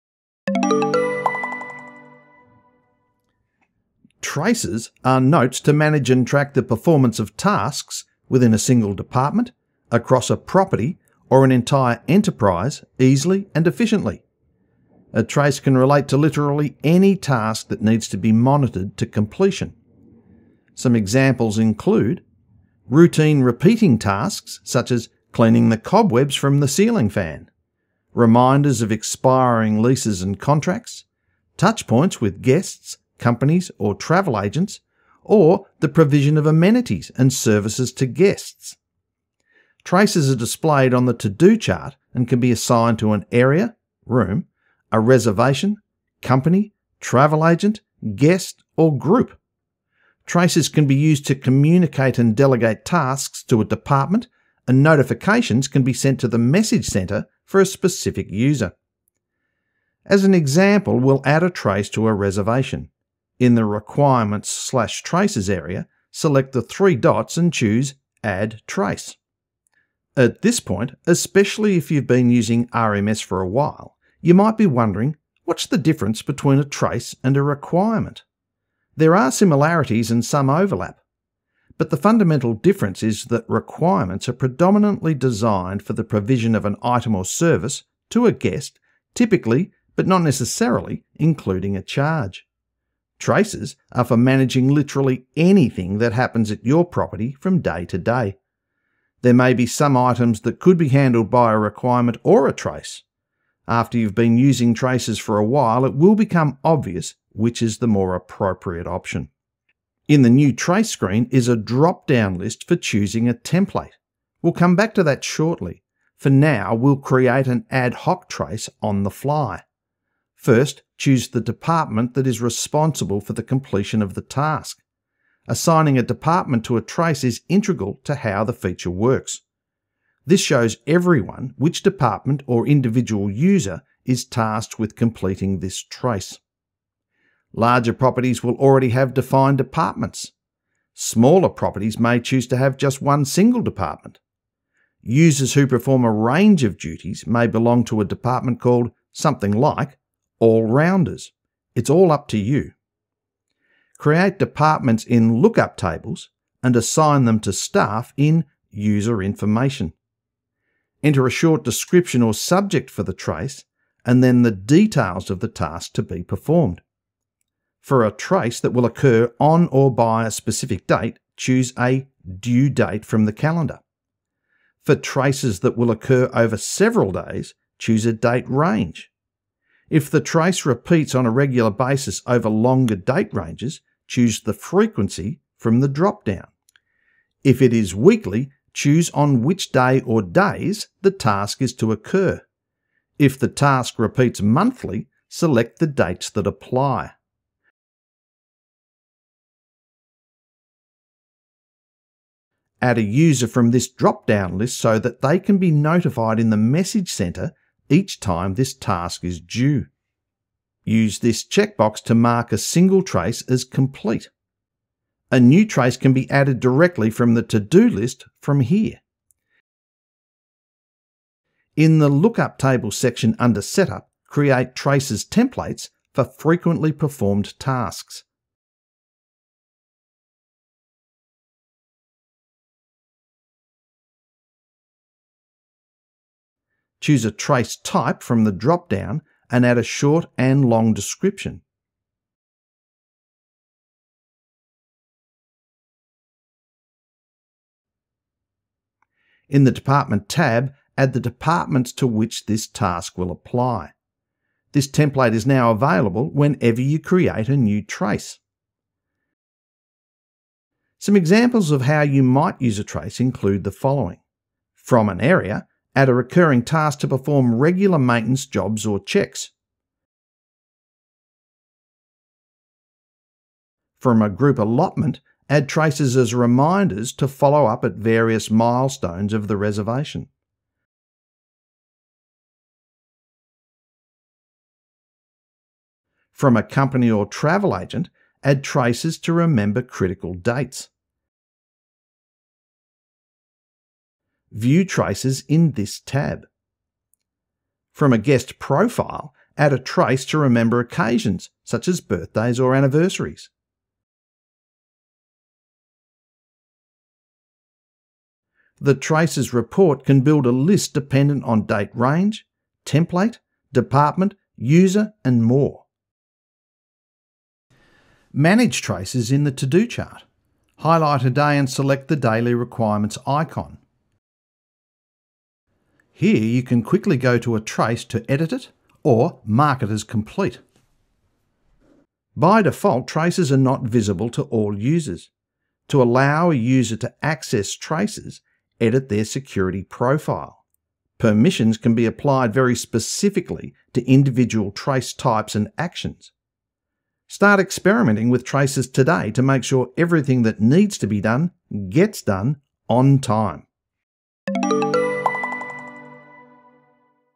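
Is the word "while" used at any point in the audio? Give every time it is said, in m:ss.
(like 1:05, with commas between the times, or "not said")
1:13, 1:45.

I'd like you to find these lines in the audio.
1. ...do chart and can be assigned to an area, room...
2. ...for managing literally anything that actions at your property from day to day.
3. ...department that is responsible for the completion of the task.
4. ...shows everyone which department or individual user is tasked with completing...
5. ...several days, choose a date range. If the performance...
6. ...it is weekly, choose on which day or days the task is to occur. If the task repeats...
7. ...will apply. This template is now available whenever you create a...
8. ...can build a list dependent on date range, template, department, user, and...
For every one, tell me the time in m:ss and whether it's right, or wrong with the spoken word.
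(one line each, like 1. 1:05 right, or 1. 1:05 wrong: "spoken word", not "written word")
1. 0:41 right
2. 1:34 wrong: "happens", not "actions"
3. 2:01 right
4. 2:10 right
5. 2:56 wrong: "trace", not "performance"
6. 3:07 right
7. 4:13 right
8. 5:10 right.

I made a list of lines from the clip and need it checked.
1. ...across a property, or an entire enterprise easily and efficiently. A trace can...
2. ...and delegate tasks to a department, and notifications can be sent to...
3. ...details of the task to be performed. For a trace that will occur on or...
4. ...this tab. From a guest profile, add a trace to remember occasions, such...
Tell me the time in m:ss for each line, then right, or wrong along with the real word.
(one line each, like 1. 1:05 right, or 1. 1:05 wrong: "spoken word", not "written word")
1. 0:09 right
2. 0:52 right
3. 2:44 right
4. 4:55 right.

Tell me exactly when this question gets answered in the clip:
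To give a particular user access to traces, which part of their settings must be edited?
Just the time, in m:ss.
5:39.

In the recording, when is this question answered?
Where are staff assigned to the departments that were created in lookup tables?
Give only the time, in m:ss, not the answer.
2:38.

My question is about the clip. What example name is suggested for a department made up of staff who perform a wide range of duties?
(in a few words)
all rounders.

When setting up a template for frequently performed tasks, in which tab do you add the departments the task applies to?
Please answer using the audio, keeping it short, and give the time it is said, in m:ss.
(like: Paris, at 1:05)
Department tab, at 4:09.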